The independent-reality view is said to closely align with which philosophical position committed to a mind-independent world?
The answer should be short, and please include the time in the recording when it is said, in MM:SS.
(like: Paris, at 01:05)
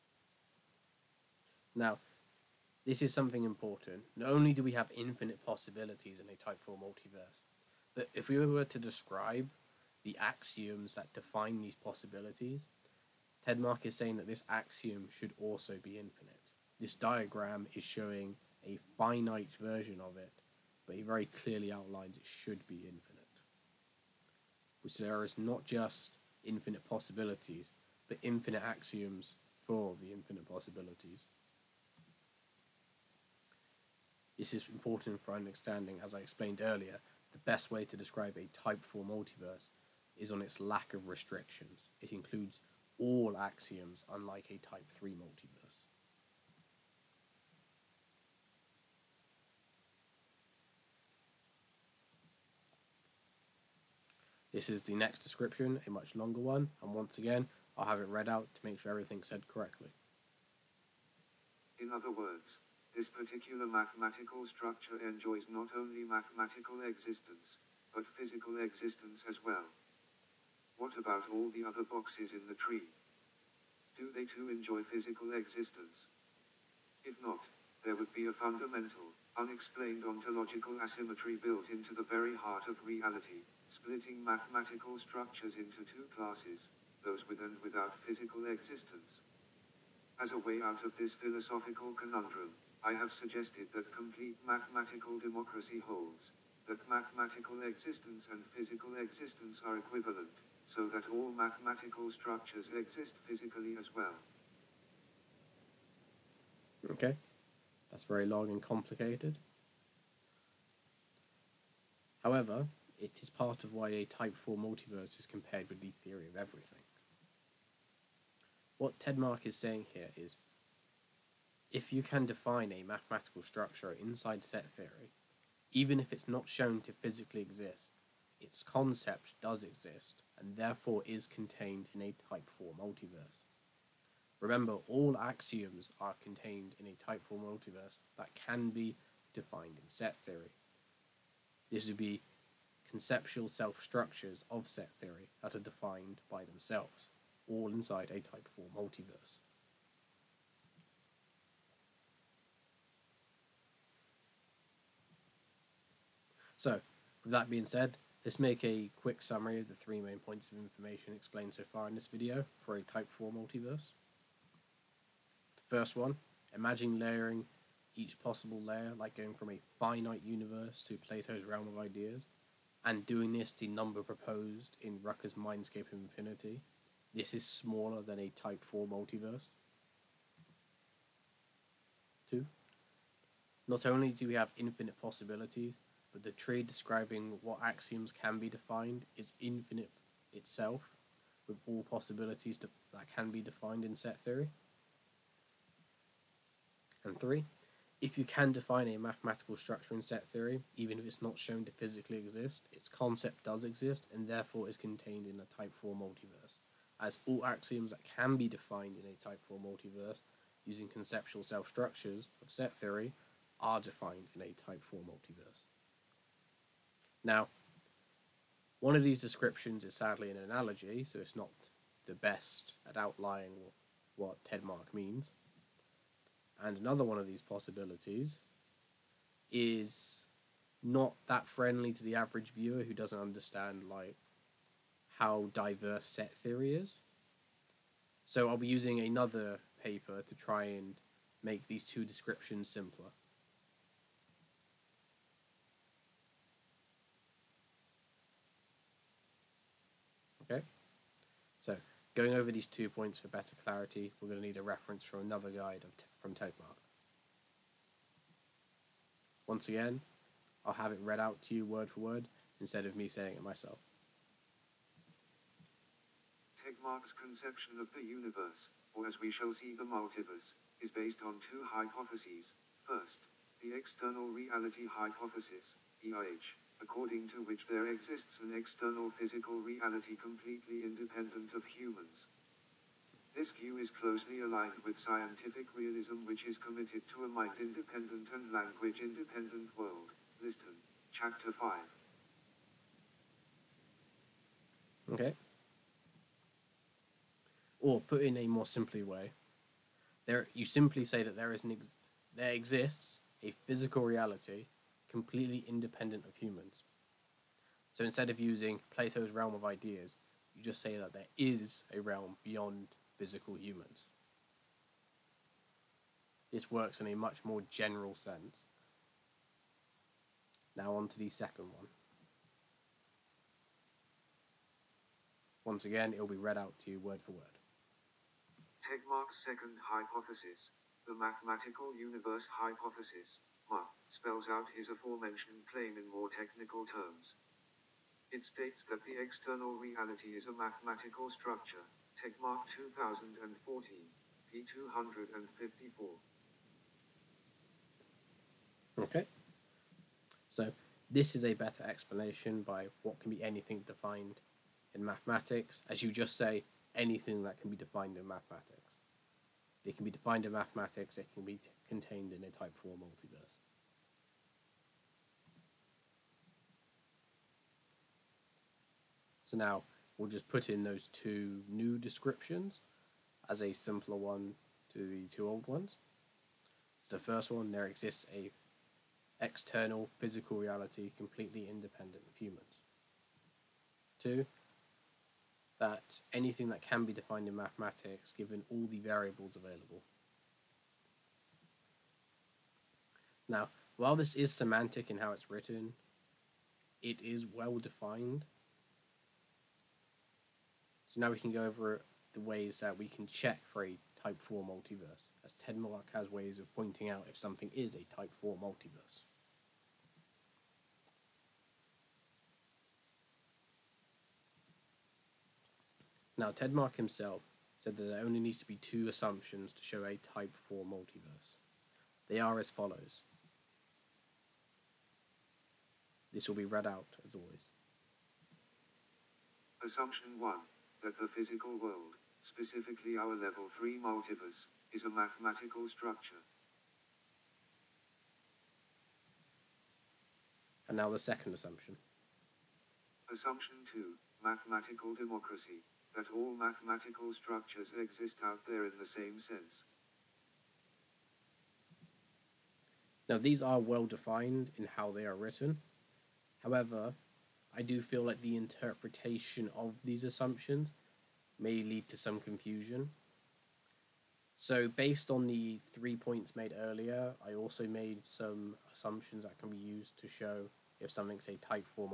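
scientific realism, at 04:44.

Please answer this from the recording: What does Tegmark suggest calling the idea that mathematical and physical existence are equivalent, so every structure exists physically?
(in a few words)
complete mathematical democracy.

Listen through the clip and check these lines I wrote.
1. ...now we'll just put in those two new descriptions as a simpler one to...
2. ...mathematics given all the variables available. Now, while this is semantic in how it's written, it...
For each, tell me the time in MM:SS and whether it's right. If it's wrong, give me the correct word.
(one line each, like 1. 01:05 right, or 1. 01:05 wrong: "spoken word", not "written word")
1. 06:09 right
2. 06:27 right.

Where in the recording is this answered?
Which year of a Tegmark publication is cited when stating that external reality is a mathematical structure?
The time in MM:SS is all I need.
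05:42.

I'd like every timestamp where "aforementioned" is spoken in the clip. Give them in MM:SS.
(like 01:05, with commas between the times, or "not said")
05:34.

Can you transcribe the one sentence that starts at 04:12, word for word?
Going over these two points for better clarity, we're going to need a reference from another guide from Tegmark.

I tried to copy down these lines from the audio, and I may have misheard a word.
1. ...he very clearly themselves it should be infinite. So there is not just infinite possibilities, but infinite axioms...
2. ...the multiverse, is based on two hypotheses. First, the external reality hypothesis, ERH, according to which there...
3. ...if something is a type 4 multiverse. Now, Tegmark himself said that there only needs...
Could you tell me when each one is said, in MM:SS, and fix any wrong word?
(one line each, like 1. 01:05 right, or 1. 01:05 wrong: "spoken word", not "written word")
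1. 00:20 wrong: "outlines", not "themselves"
2. 04:29 right
3. 06:47 right.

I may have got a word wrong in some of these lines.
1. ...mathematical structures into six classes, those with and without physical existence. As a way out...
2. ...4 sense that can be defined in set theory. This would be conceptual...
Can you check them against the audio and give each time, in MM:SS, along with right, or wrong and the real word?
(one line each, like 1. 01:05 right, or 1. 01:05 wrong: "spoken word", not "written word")
1. 01:24 wrong: "two", not "six"
2. 02:17 wrong: "multiverse", not "sense".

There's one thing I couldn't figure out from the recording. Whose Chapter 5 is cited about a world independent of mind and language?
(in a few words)
Liston.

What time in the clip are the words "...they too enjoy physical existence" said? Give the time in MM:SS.
01:14.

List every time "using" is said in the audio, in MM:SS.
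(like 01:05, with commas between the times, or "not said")
03:30, 03:58, 05:08.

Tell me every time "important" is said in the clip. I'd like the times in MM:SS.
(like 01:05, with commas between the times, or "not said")
00:03, 00:34.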